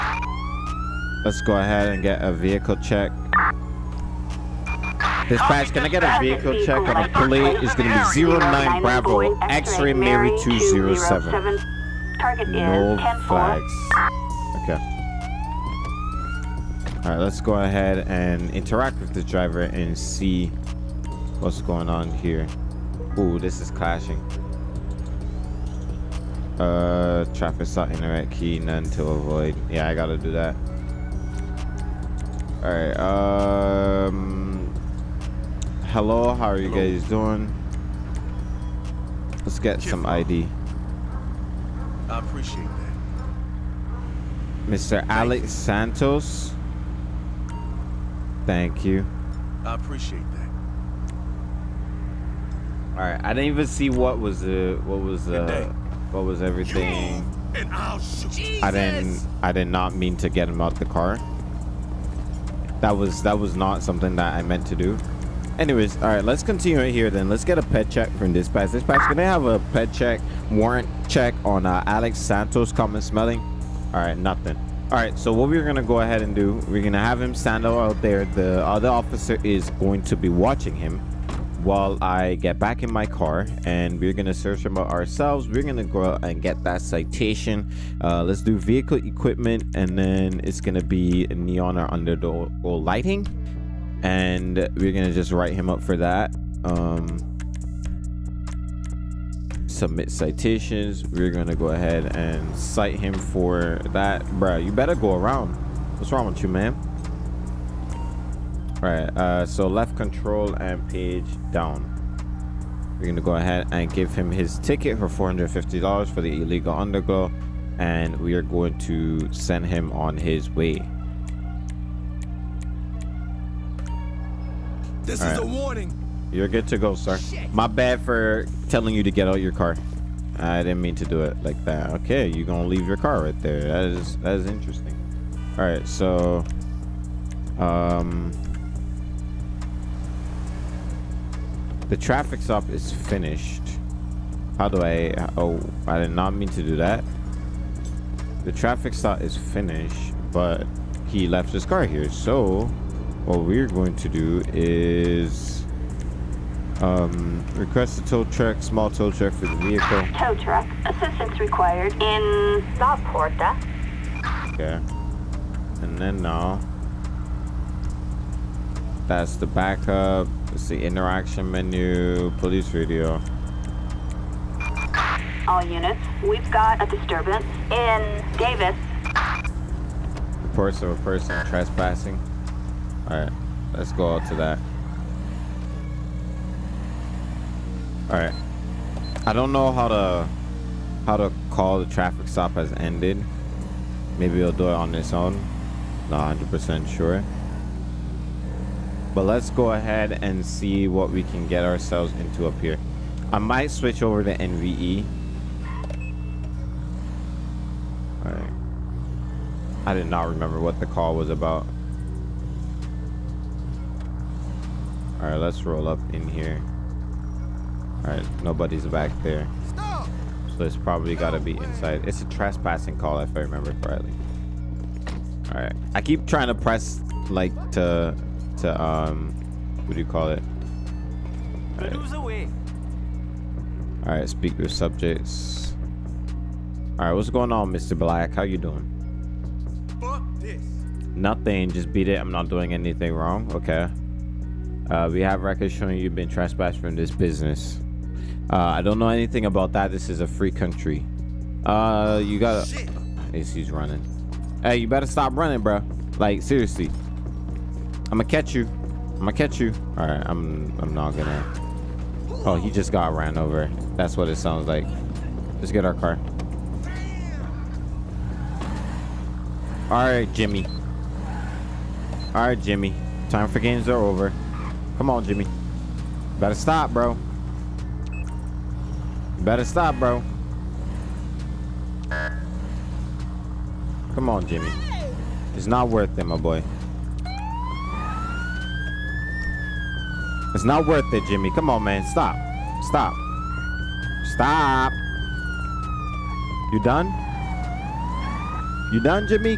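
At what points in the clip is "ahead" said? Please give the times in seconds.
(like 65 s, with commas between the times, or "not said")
1 s, 17 s, 76 s, 101 s, 113 s, 199 s.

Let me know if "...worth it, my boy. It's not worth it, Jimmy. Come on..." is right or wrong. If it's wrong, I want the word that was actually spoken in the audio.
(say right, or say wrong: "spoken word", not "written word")
right.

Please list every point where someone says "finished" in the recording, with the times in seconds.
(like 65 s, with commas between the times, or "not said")
142 s, 149 s.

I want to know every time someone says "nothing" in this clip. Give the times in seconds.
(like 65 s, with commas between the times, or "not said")
74 s, 241 s.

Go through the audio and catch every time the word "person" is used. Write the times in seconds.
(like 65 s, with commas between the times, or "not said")
181 s.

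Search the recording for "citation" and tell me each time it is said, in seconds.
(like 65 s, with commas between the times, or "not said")
86 s, 100 s.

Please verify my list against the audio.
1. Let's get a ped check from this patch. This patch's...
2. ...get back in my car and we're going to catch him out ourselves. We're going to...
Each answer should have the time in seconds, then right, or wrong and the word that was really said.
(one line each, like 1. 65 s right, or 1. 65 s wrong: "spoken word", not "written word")
1. 67 s right
2. 82 s wrong: "search", not "catch".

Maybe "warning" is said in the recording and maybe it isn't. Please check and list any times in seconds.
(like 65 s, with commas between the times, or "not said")
125 s.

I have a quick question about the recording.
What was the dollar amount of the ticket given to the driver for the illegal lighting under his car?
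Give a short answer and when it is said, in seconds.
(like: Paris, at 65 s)
$450, at 115 s.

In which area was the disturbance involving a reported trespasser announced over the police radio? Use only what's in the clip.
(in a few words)
Davis.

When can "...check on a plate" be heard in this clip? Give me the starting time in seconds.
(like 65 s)
6 s.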